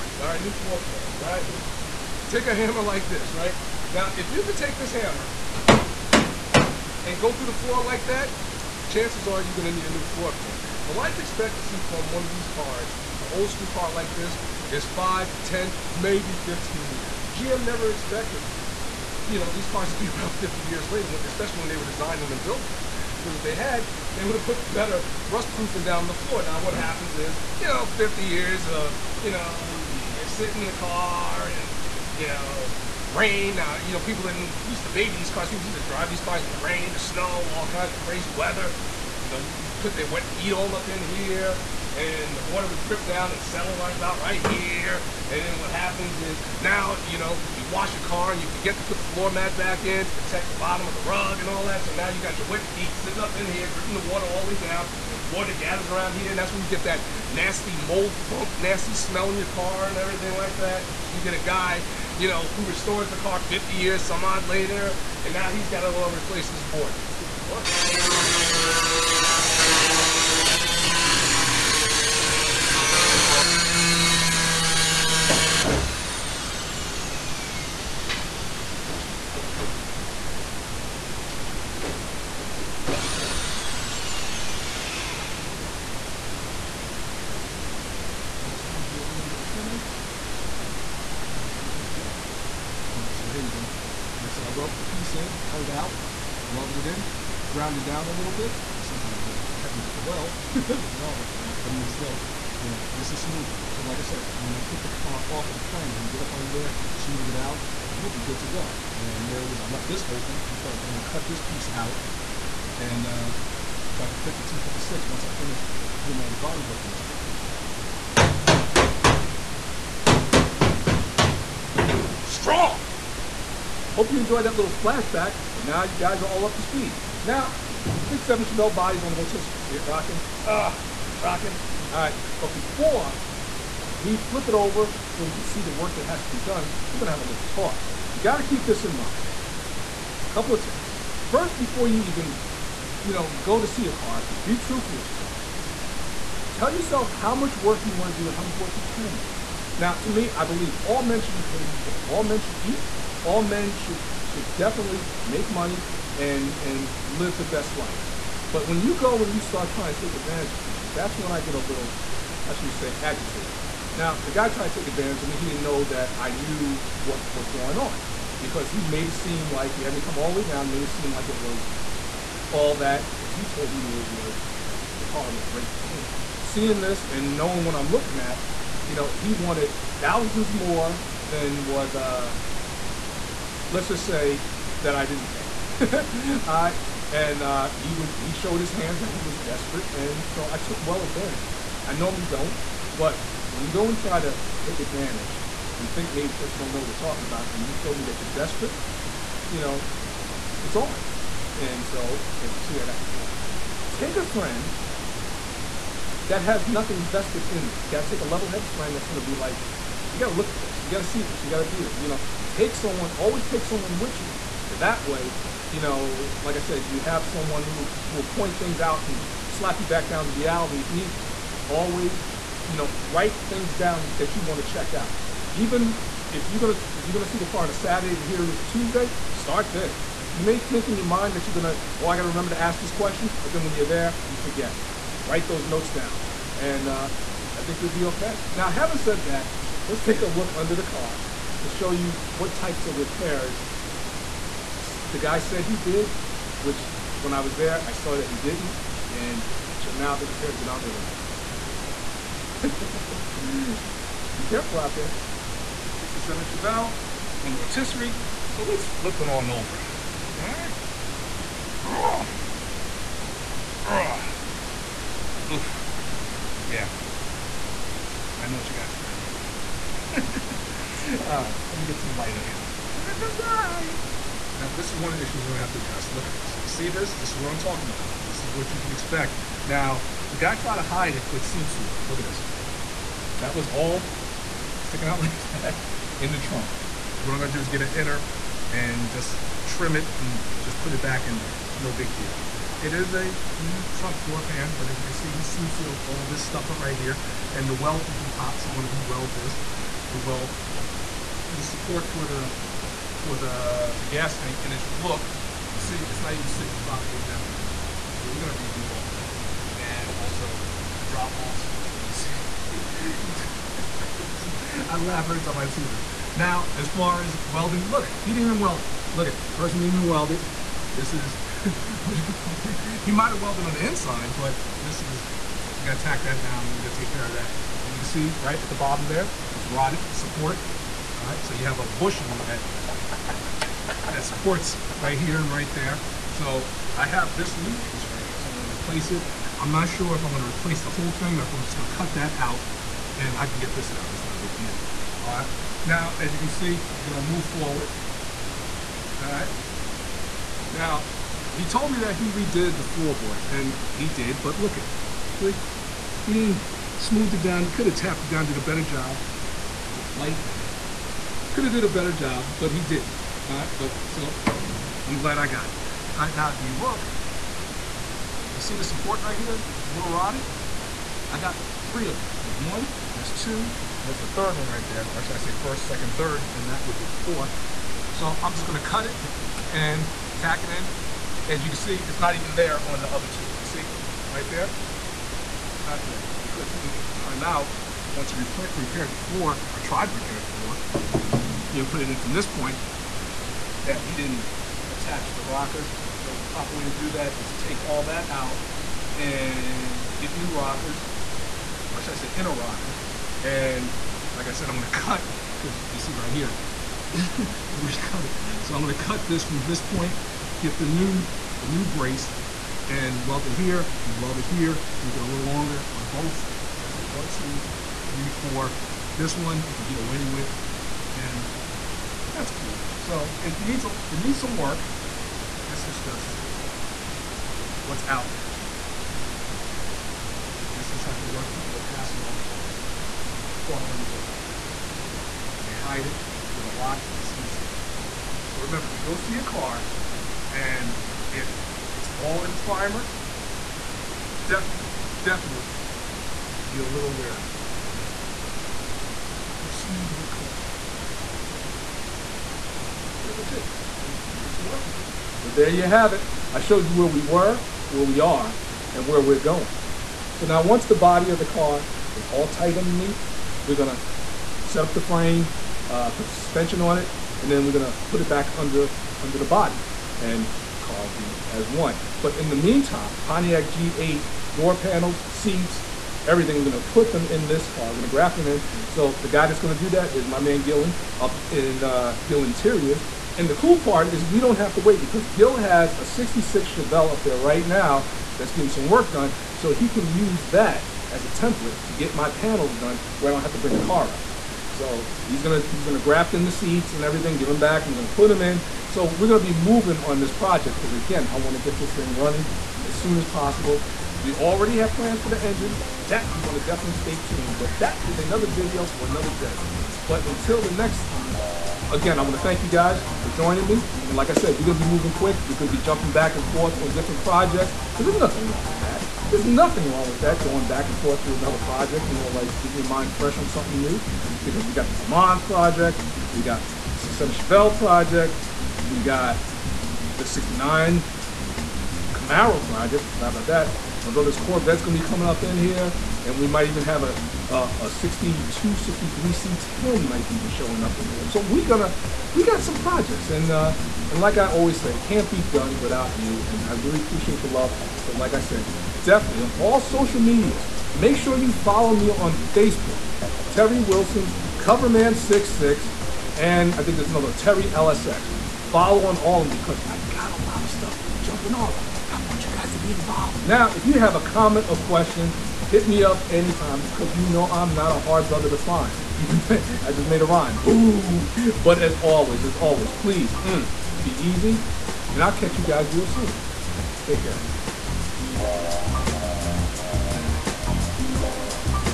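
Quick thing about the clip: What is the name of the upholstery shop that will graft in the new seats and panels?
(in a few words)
Gill Interiors.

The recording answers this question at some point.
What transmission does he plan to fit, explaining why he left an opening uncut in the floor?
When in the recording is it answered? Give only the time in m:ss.
1:54.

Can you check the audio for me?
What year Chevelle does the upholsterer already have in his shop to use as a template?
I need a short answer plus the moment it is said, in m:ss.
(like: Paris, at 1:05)
1966, at 8:06.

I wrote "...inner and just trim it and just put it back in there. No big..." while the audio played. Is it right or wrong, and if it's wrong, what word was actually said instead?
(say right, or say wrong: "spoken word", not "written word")
right.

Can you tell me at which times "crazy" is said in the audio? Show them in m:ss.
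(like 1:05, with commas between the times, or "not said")
0:38.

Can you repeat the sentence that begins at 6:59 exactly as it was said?
This one I can get away with and that's cool.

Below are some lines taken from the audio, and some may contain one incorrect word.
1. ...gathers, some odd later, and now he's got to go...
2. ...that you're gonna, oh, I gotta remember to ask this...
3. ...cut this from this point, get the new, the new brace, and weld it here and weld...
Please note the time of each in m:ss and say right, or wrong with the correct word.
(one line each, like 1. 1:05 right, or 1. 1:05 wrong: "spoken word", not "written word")
1. 1:03 wrong: "years", not "gathers"
2. 3:51 right
3. 6:48 right.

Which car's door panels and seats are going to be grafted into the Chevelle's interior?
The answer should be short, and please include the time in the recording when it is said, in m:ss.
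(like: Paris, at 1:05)
Pontiac G8, at 7:53.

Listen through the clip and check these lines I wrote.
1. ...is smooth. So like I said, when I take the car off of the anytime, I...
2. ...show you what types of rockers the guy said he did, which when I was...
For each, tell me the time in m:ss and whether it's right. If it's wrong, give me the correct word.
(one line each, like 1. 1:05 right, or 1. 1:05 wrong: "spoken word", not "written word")
1. 1:43 wrong: "frame", not "anytime"
2. 4:01 wrong: "repairs", not "rockers".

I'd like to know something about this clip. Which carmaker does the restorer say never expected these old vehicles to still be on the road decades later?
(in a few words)
GM.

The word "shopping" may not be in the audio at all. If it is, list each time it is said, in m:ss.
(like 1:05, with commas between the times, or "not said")
not said.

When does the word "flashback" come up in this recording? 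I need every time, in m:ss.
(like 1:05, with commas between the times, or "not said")
2:04.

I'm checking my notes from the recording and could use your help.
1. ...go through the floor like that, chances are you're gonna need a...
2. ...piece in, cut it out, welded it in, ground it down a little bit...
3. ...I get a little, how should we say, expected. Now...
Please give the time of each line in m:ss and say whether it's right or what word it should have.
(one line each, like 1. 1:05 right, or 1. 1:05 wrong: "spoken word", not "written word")
1. 0:07 right
2. 1:34 right
3. 2:41 wrong: "agitated", not "expected".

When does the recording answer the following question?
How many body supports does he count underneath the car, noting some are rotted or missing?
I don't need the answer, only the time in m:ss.
6:17.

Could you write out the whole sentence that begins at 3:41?
Always, you know, write things down that you want to check out.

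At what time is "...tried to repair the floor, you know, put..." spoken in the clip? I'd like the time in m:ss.
6:29.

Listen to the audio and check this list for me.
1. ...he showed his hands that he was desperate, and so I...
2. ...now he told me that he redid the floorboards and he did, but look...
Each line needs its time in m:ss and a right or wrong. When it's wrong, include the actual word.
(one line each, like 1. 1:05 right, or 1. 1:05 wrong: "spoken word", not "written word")
1. 3:08 right
2. 5:50 right.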